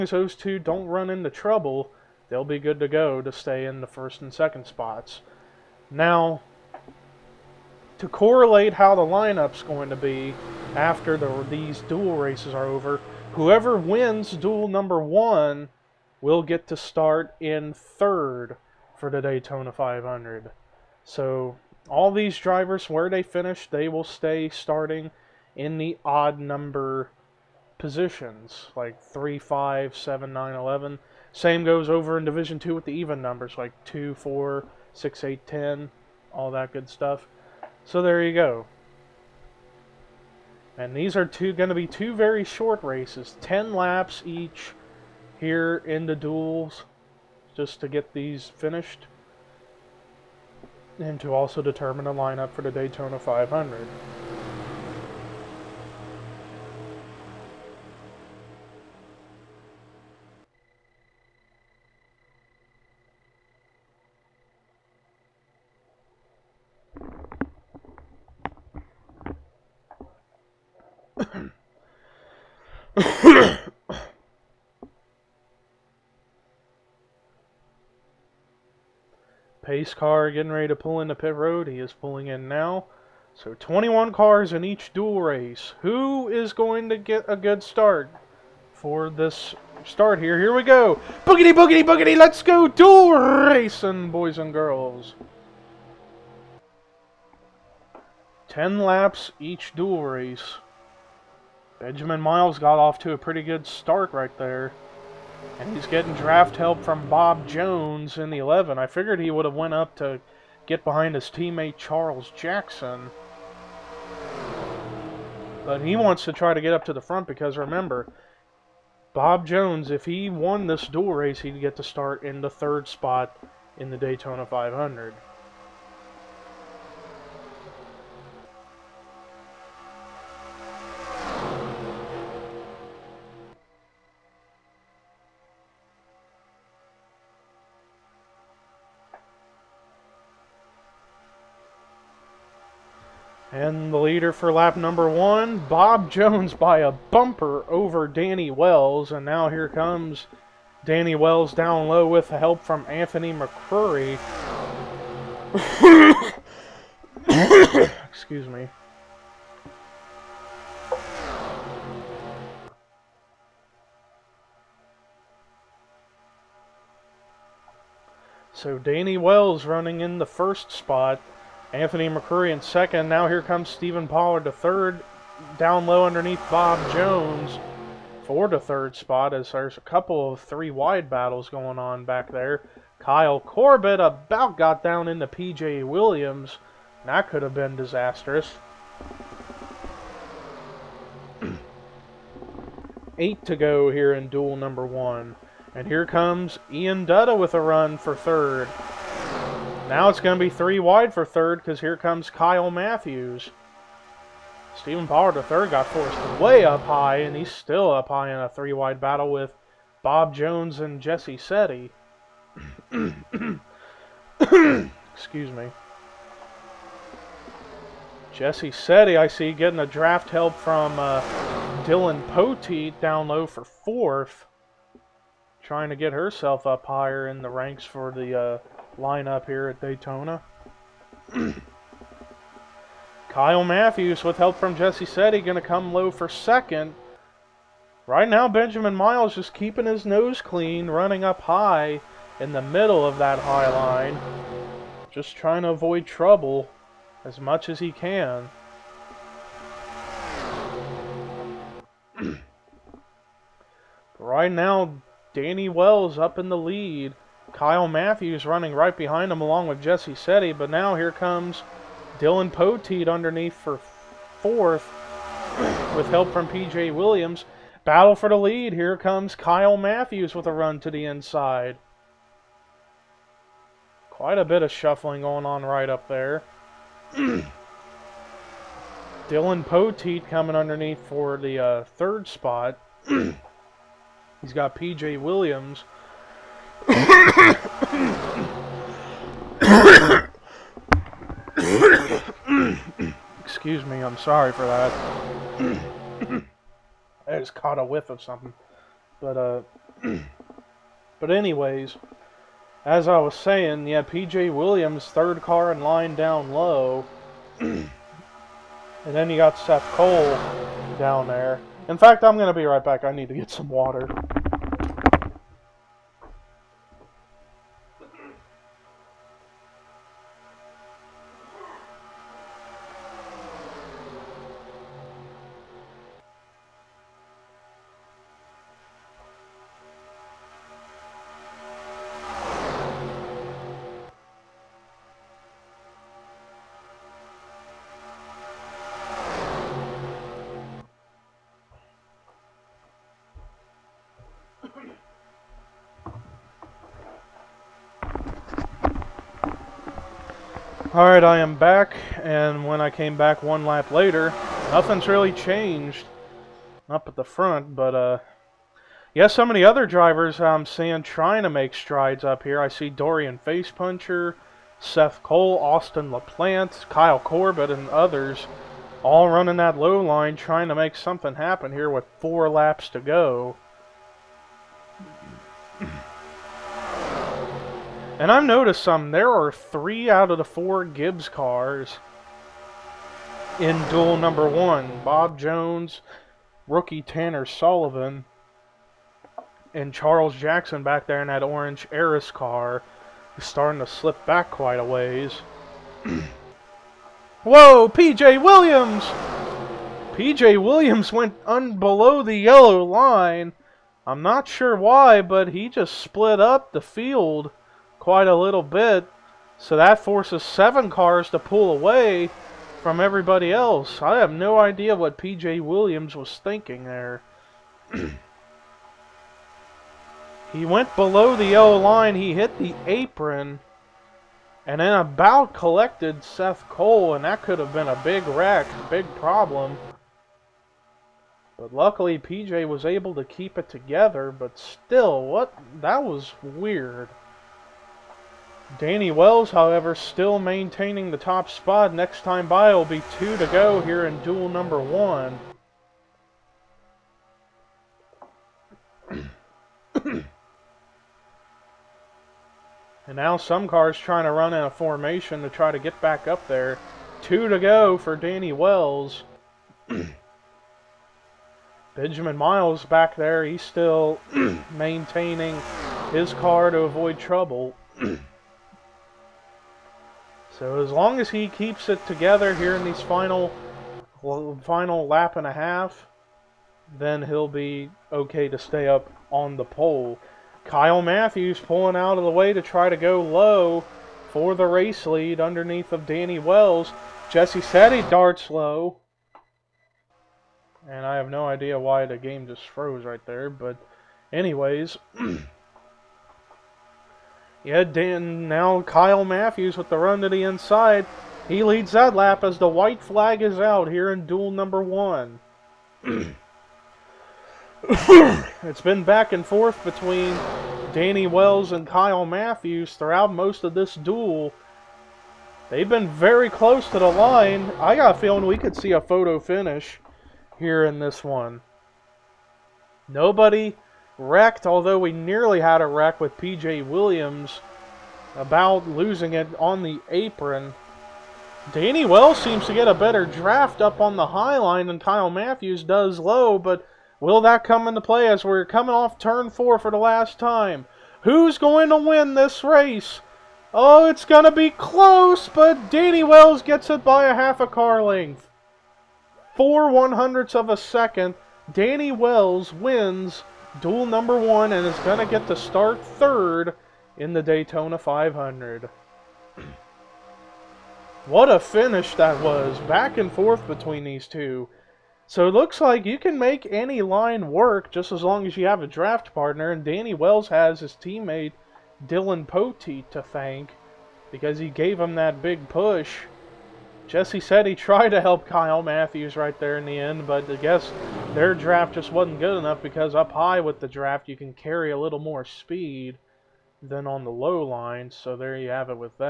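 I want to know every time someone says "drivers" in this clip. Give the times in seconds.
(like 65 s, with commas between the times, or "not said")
22 s, 359 s.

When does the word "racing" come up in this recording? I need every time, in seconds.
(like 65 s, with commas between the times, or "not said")
93 s.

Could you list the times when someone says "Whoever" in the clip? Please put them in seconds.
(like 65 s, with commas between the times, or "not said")
13 s.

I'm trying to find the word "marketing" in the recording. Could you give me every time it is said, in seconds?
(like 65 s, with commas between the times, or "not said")
not said.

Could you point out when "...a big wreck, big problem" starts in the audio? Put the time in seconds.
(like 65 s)
427 s.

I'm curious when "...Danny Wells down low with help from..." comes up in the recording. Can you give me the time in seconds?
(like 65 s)
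150 s.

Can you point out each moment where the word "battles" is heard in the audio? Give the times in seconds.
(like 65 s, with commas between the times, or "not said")
181 s, 208 s, 267 s.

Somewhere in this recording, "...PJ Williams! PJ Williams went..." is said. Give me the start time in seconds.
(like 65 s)
397 s.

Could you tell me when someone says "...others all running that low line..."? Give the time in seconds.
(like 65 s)
367 s.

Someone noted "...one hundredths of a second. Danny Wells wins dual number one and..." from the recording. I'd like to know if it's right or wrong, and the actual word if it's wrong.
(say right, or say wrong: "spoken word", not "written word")
right.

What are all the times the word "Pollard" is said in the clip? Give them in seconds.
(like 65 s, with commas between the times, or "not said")
174 s, 205 s.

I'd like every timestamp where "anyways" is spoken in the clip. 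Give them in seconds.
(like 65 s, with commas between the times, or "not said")
301 s, 494 s.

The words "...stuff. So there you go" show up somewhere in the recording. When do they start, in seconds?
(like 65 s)
36 s.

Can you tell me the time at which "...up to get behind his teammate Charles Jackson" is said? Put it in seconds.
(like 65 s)
109 s.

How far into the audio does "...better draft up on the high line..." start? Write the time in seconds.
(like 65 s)
532 s.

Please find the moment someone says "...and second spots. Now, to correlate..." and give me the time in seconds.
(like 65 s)
4 s.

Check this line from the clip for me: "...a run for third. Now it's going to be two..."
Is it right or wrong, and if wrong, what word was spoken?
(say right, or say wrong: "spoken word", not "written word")
wrong: "three", not "two".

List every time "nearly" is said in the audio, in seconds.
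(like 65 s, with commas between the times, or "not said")
525 s.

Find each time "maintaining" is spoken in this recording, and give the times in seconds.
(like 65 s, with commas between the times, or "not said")
440 s, 464 s.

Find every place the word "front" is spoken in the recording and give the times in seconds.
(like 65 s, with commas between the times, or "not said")
117 s, 357 s.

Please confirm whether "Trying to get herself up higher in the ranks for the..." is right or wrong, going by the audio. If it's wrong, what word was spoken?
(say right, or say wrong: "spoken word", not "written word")
right.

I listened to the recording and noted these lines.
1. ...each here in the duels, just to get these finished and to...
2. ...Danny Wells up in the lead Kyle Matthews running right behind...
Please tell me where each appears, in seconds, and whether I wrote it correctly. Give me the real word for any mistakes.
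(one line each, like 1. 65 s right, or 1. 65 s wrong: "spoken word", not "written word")
1. 44 s right
2. 255 s right.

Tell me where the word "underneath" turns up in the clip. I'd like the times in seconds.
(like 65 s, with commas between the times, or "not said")
176 s, 263 s, 280 s, 485 s.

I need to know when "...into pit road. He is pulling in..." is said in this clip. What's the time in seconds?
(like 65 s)
81 s.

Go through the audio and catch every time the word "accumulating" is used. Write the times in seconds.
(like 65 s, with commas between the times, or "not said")
not said.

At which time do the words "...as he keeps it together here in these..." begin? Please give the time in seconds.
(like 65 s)
471 s.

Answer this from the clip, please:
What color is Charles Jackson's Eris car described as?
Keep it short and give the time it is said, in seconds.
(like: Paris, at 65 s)
orange, at 391 s.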